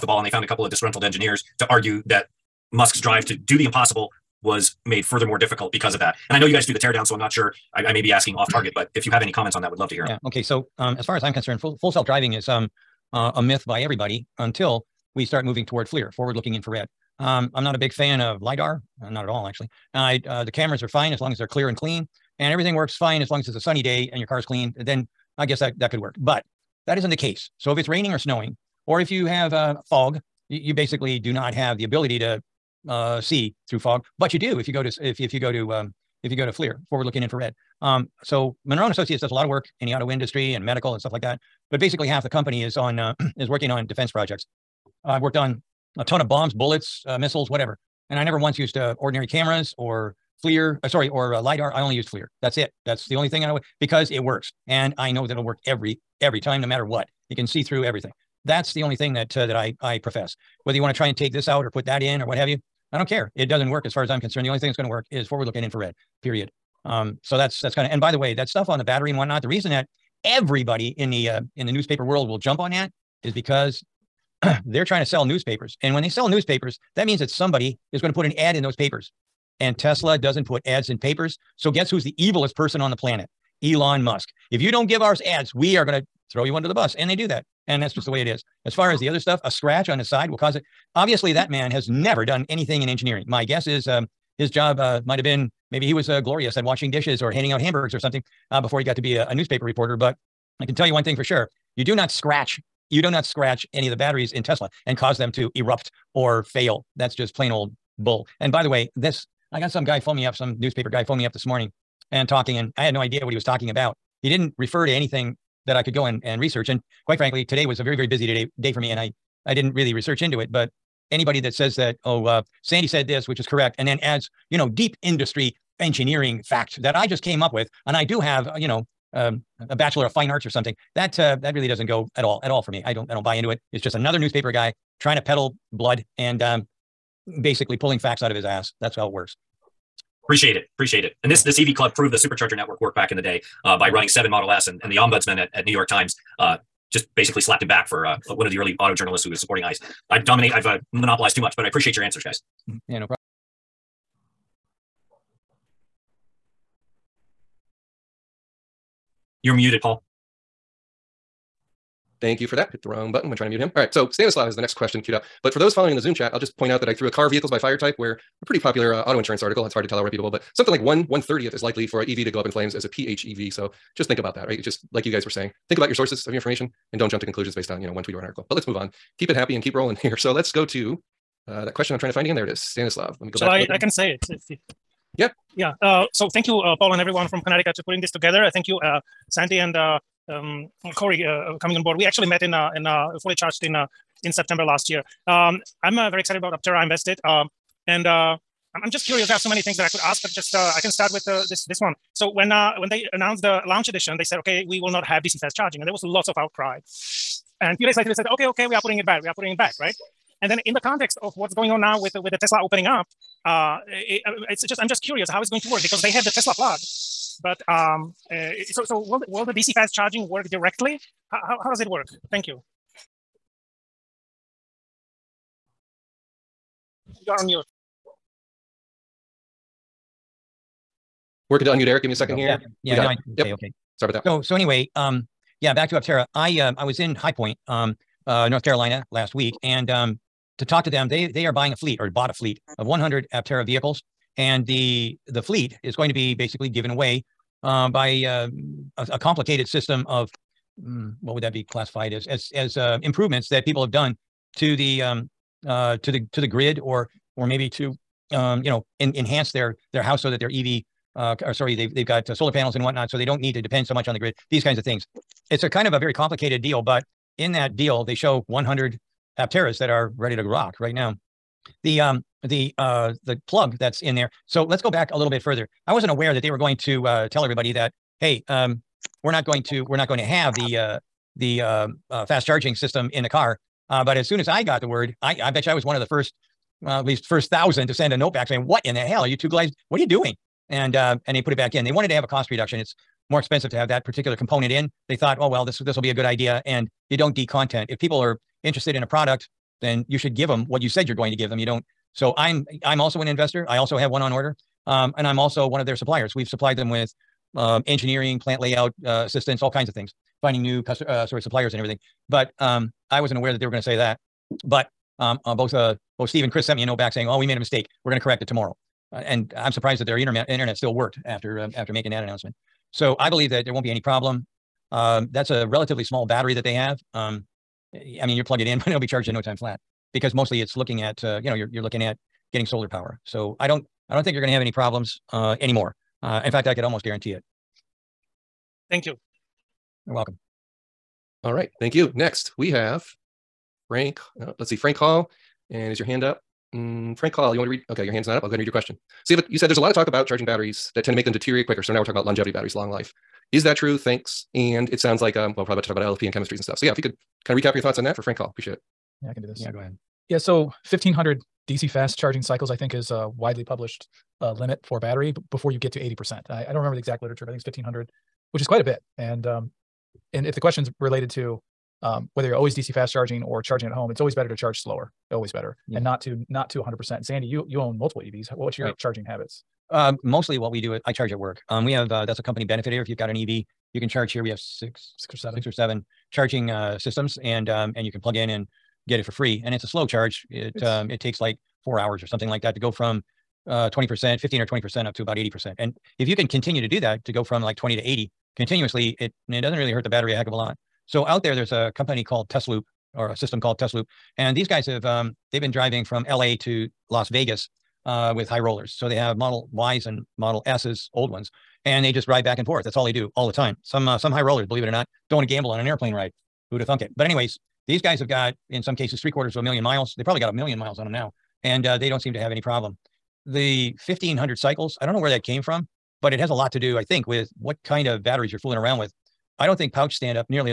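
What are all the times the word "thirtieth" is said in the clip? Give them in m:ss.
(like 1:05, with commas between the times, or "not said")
2:51.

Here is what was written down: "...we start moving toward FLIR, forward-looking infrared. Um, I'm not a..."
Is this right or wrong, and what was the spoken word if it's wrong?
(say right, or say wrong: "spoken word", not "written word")
right.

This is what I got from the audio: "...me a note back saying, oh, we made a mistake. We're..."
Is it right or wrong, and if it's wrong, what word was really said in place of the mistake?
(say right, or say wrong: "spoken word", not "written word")
right.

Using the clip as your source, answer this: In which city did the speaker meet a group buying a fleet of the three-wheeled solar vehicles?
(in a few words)
High Point.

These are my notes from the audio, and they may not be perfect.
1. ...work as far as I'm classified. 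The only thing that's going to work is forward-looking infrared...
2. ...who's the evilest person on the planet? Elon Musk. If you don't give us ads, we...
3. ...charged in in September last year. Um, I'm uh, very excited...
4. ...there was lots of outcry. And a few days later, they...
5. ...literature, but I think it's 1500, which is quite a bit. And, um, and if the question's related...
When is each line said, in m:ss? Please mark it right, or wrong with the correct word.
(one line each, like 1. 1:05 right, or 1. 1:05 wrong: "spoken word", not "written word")
1. 1:03 wrong: "concerned", not "classified"
2. 1:21 right
3. 3:13 right
4. 3:25 right
5. 6:07 right.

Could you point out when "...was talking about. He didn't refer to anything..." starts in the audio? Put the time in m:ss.
1:53.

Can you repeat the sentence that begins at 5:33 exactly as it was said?
So I don't I don't think you're going to have any problems uh, anymore.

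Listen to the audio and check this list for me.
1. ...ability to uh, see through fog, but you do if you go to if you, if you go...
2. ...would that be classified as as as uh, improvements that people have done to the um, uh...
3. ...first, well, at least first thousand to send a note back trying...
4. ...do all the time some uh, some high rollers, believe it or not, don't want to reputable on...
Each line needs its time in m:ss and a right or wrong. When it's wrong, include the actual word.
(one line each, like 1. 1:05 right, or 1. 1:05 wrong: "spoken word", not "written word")
1. 0:31 right
2. 4:11 right
3. 4:46 wrong: "saying", not "trying"
4. 6:53 wrong: "gamble", not "reputable".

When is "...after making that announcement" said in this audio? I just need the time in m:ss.
5:21.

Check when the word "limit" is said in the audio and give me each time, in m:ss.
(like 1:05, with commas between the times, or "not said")
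6:04.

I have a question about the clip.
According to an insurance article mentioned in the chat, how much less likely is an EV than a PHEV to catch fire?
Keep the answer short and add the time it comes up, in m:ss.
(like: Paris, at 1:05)
1/30, at 2:50.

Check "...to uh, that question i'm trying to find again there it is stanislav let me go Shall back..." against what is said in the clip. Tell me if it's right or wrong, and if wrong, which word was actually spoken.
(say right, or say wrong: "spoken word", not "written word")
right.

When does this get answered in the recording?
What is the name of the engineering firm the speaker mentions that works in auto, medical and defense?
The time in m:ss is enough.
0:38.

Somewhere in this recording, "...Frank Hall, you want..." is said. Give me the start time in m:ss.
5:47.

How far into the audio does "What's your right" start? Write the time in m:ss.
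6:18.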